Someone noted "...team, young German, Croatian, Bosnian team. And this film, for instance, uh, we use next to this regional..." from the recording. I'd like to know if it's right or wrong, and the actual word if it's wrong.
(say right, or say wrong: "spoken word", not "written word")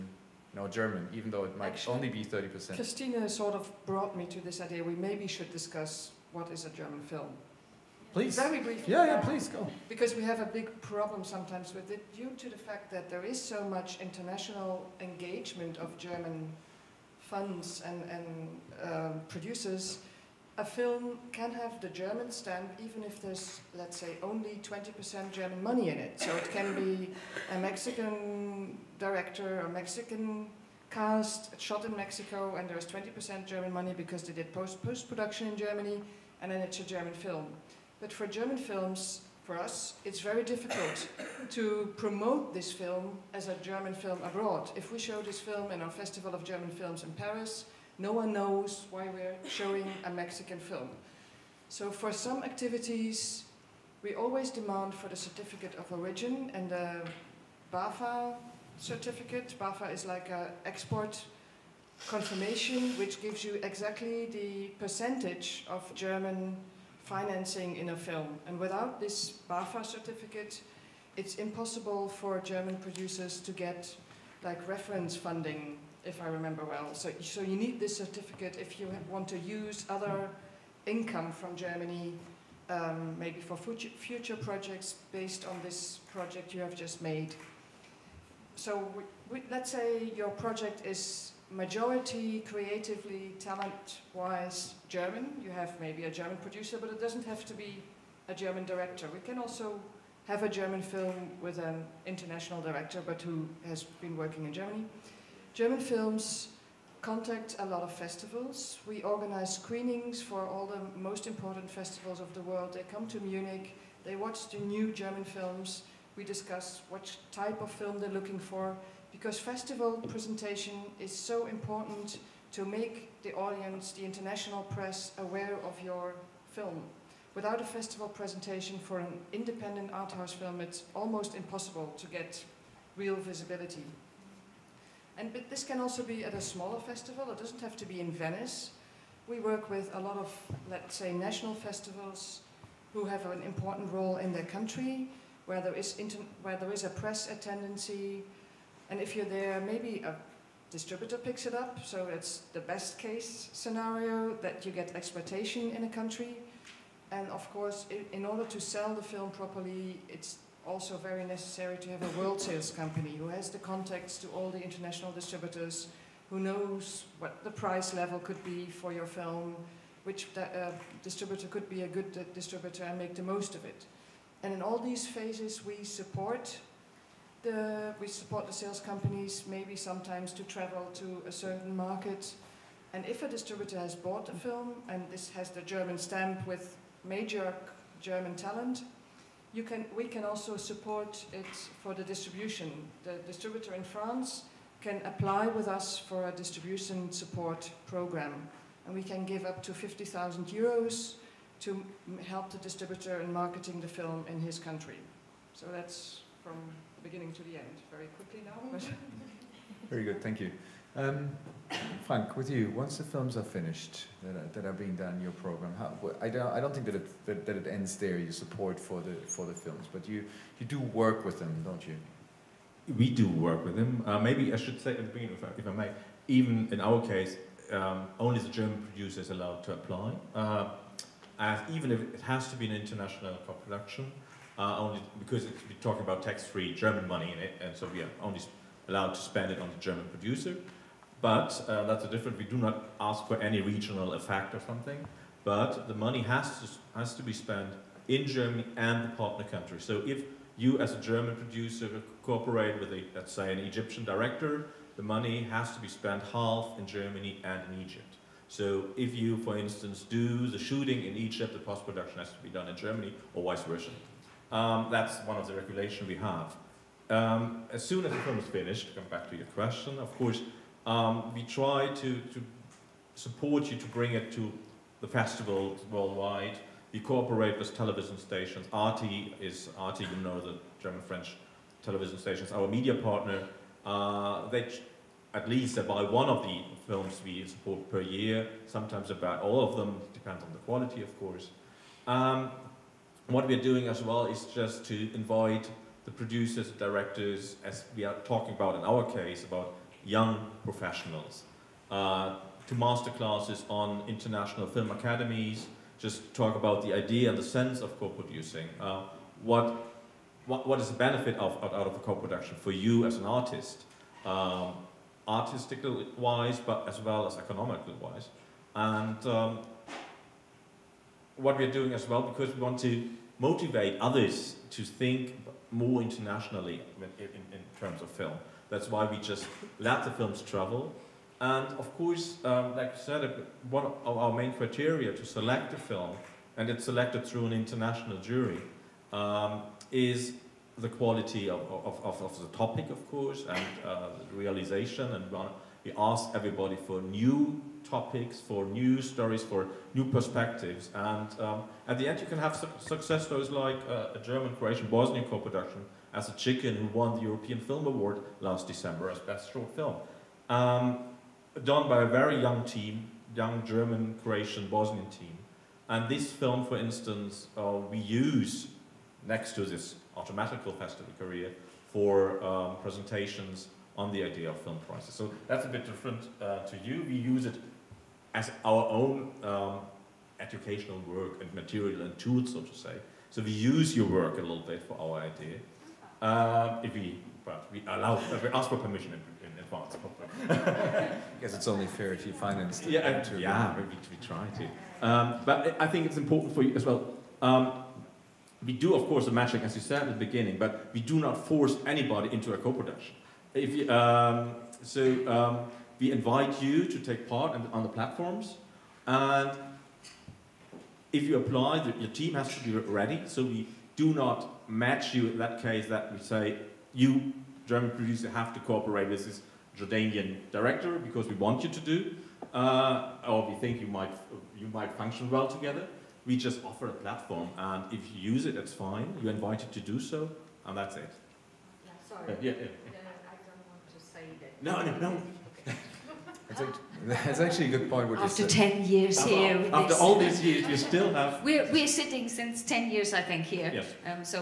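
wrong: "automatical", not "regional".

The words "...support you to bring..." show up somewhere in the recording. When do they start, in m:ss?
4:33.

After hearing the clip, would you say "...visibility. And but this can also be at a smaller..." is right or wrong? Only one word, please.
right.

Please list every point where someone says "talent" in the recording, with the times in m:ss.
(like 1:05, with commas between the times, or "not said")
1:33, 3:08.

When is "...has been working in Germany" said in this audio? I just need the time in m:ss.
1:43.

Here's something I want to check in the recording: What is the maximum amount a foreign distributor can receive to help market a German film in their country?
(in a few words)
50,000 euros.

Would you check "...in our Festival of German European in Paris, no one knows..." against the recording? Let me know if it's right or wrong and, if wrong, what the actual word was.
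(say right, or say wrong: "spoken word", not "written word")
wrong: "Films", not "European".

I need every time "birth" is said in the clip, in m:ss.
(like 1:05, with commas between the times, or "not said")
not said.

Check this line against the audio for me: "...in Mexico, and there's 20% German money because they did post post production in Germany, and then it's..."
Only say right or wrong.
right.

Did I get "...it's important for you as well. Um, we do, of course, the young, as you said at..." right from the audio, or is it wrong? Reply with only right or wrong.
wrong.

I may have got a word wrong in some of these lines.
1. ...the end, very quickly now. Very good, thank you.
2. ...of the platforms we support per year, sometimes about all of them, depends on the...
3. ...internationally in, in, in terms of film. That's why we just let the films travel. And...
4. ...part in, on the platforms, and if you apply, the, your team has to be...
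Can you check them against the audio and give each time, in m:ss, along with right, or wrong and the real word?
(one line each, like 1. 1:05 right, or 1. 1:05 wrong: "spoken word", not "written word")
1. 3:27 right
2. 4:46 wrong: "films", not "platforms"
3. 5:26 right
4. 6:47 right.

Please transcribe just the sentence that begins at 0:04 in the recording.
We maybe should discuss what is a German film.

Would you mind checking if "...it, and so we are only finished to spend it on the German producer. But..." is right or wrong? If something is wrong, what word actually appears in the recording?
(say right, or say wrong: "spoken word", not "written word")
wrong: "allowed", not "finished".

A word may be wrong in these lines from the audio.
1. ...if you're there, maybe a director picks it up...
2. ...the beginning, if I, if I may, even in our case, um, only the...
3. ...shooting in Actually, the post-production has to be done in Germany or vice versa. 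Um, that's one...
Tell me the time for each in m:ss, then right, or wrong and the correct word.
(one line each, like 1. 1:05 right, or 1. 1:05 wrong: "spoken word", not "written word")
1. 2:29 wrong: "distributor", not "director"
2. 3:44 right
3. 4:20 wrong: "Egypt", not "Actually".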